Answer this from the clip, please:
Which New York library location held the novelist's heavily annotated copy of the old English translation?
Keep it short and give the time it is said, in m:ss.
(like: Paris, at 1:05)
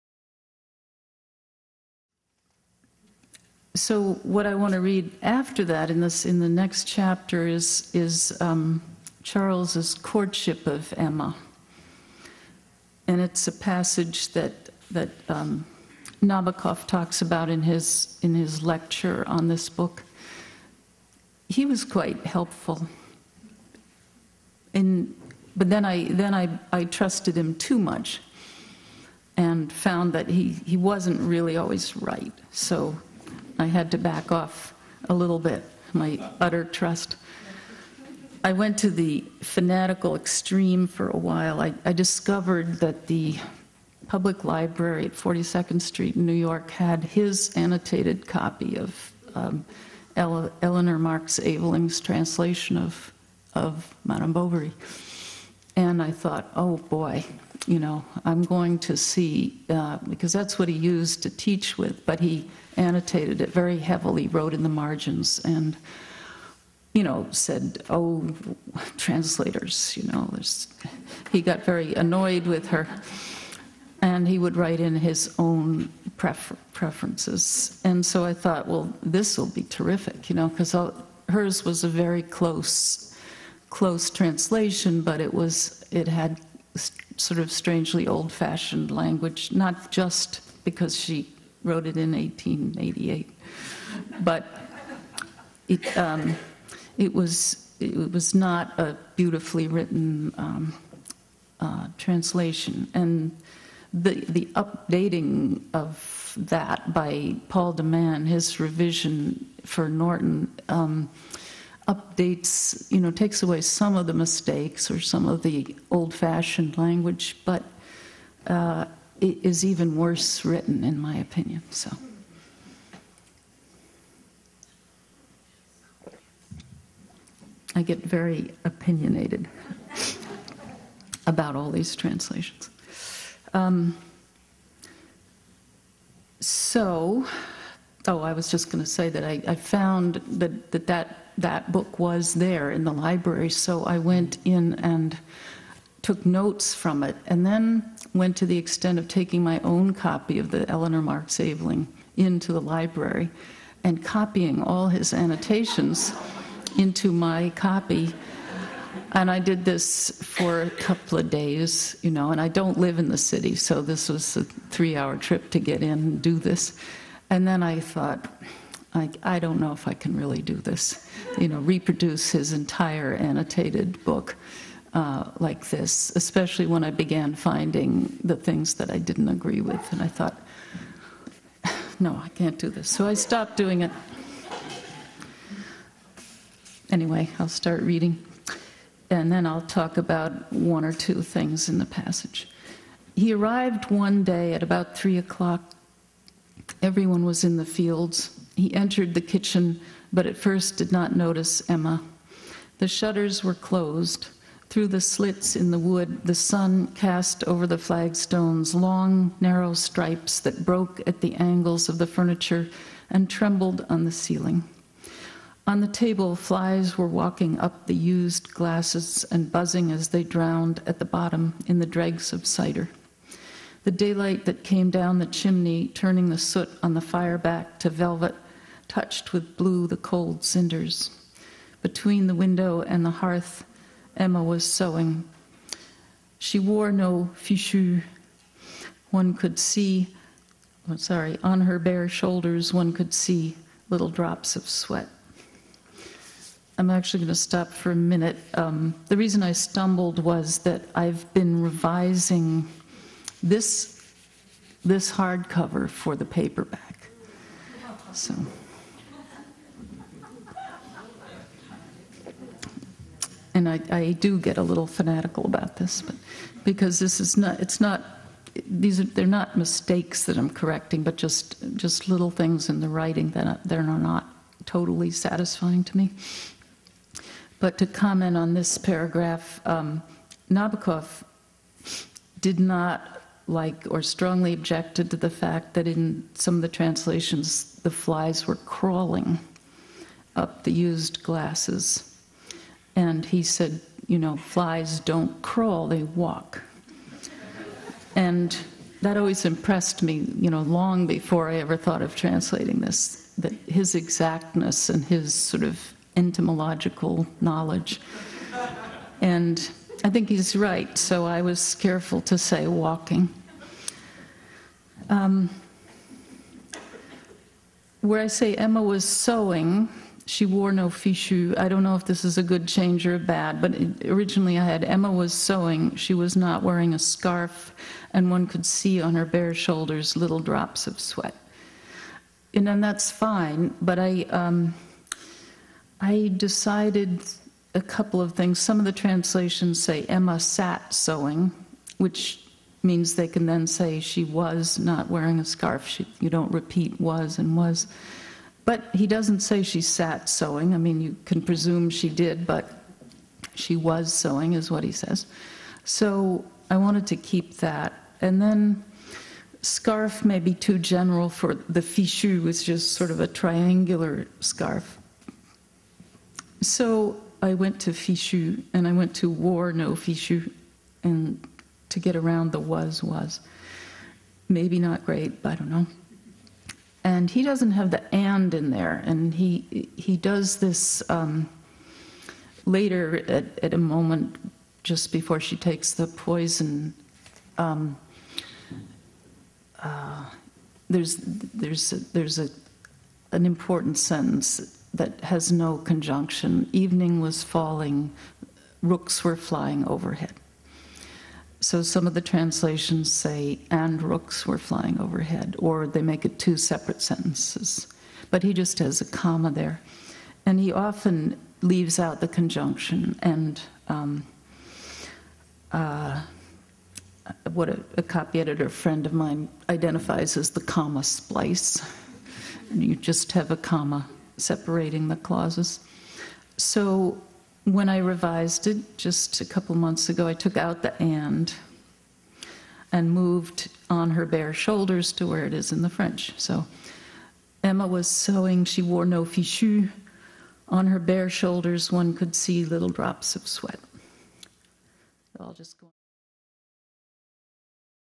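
42nd Street, at 0:45.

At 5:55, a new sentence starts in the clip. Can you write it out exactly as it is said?
So I wanted to keep that.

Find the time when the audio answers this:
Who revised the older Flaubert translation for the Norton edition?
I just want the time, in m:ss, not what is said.
1:47.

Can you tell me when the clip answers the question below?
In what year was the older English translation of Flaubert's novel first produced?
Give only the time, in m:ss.
1:32.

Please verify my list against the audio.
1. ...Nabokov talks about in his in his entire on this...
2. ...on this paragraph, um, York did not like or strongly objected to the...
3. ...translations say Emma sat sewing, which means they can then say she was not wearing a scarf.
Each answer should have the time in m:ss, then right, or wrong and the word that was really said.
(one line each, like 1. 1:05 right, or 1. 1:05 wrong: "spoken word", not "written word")
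1. 0:16 wrong: "lecture", not "entire"
2. 4:38 wrong: "Nabokov", not "York"
3. 5:38 right.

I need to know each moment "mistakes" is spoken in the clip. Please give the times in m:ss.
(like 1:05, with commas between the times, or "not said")
1:54, 4:29.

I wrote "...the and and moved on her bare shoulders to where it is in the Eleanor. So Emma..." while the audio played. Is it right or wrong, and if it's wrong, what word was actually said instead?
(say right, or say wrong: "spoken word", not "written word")
wrong: "French", not "Eleanor".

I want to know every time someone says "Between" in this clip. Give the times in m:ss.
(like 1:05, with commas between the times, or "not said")
3:51.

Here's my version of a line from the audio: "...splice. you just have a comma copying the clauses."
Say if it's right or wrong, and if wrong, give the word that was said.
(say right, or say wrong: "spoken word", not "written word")
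wrong: "separating", not "copying".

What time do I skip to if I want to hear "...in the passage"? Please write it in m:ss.
3:11.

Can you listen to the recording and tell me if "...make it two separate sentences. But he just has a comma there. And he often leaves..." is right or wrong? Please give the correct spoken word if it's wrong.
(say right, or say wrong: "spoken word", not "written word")
right.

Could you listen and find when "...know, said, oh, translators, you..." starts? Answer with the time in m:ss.
1:07.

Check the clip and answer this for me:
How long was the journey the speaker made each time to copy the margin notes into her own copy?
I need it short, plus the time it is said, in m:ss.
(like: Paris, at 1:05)
three hour, at 2:44.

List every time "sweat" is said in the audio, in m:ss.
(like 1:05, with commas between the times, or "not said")
4:04, 5:30, 7:23.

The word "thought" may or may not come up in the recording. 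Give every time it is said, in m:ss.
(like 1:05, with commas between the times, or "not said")
0:56, 1:18, 2:47, 3:00, 5:01.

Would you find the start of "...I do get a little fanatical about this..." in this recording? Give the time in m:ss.
4:23.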